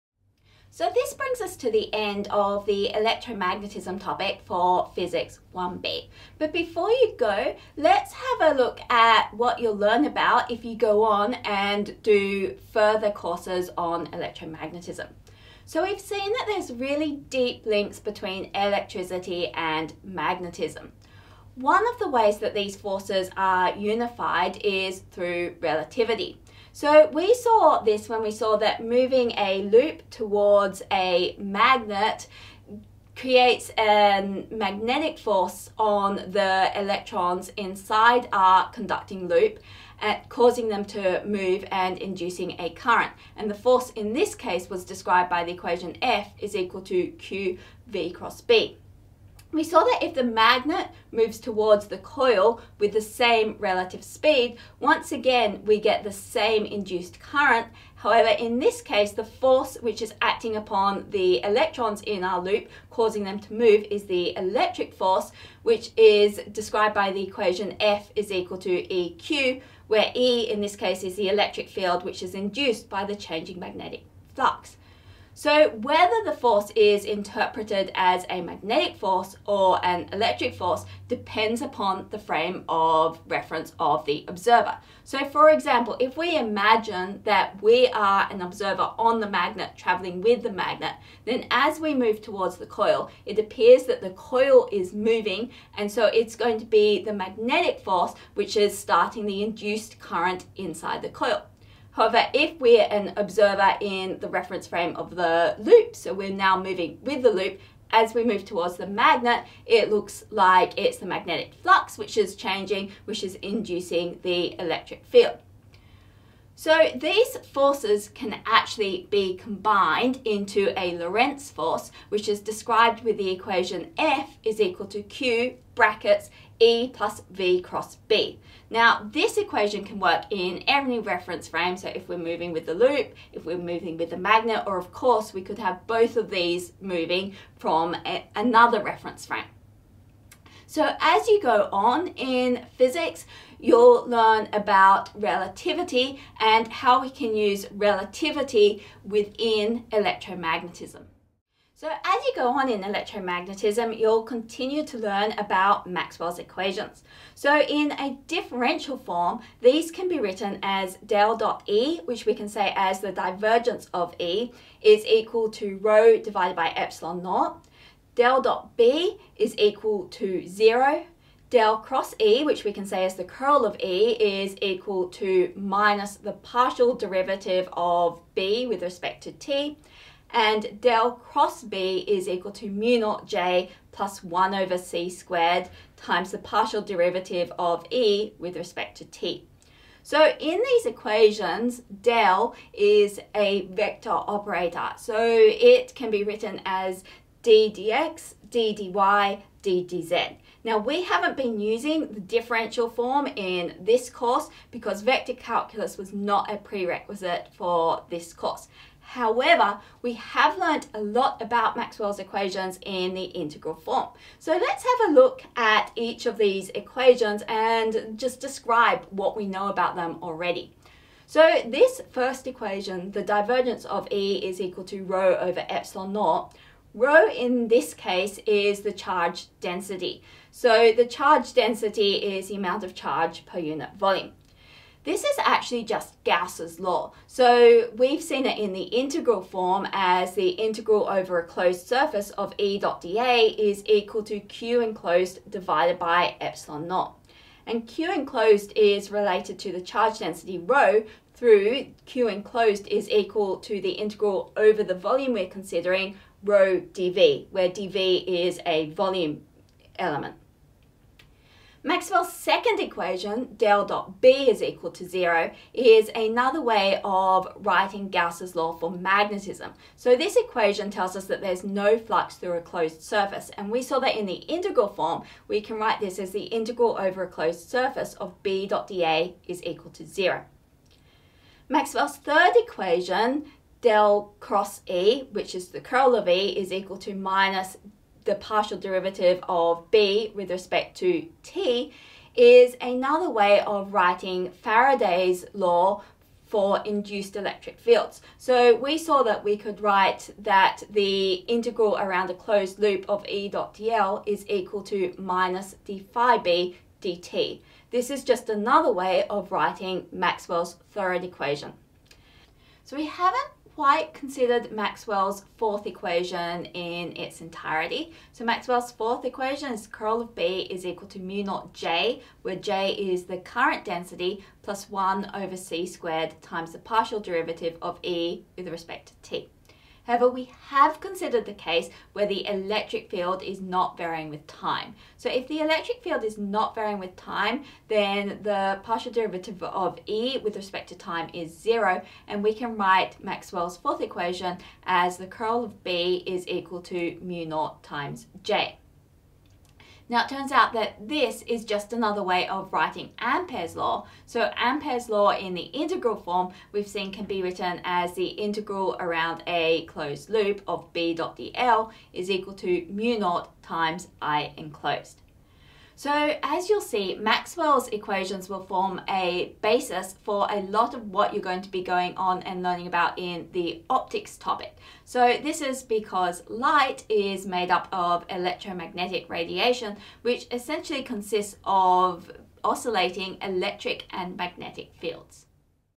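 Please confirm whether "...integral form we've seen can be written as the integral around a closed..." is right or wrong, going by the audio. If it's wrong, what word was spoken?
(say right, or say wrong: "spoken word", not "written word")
right.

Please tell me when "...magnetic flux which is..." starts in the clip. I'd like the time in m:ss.
1:51.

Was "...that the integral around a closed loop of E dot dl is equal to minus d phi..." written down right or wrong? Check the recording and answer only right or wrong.
right.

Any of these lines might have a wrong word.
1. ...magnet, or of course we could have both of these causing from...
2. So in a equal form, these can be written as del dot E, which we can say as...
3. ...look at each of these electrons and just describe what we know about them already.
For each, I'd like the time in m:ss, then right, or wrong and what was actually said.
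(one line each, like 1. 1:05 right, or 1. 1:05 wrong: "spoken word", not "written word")
1. 2:14 wrong: "moving", not "causing"
2. 2:37 wrong: "differential", not "equal"
3. 3:35 wrong: "equations", not "electrons".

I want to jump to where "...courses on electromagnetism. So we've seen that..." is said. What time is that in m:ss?
0:13.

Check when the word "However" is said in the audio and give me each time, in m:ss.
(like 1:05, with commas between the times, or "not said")
0:57, 1:41, 3:28, 5:30.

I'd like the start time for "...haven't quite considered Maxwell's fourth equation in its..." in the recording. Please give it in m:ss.
5:13.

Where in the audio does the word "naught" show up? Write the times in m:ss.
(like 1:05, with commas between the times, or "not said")
2:47, 3:02, 3:46, 4:06, 5:21, 5:47, 6:03.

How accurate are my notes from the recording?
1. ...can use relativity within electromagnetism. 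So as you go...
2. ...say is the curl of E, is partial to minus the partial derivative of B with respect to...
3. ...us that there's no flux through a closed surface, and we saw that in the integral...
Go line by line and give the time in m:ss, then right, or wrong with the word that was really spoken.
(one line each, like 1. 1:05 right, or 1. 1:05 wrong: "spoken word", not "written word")
1. 2:27 right
2. 2:52 wrong: "equal", not "partial"
3. 4:31 right.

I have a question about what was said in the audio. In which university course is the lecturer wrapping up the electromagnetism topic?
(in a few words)
Physics 1b.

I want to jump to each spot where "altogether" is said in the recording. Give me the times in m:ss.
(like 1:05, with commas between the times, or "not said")
not said.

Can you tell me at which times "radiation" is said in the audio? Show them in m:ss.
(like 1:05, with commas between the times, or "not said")
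6:19.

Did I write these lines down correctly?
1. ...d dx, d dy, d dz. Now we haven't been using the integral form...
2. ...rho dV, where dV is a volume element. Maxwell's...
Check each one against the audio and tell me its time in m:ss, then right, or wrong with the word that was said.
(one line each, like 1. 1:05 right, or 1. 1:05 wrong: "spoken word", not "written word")
1. 3:17 wrong: "differential", not "integral"
2. 4:16 right.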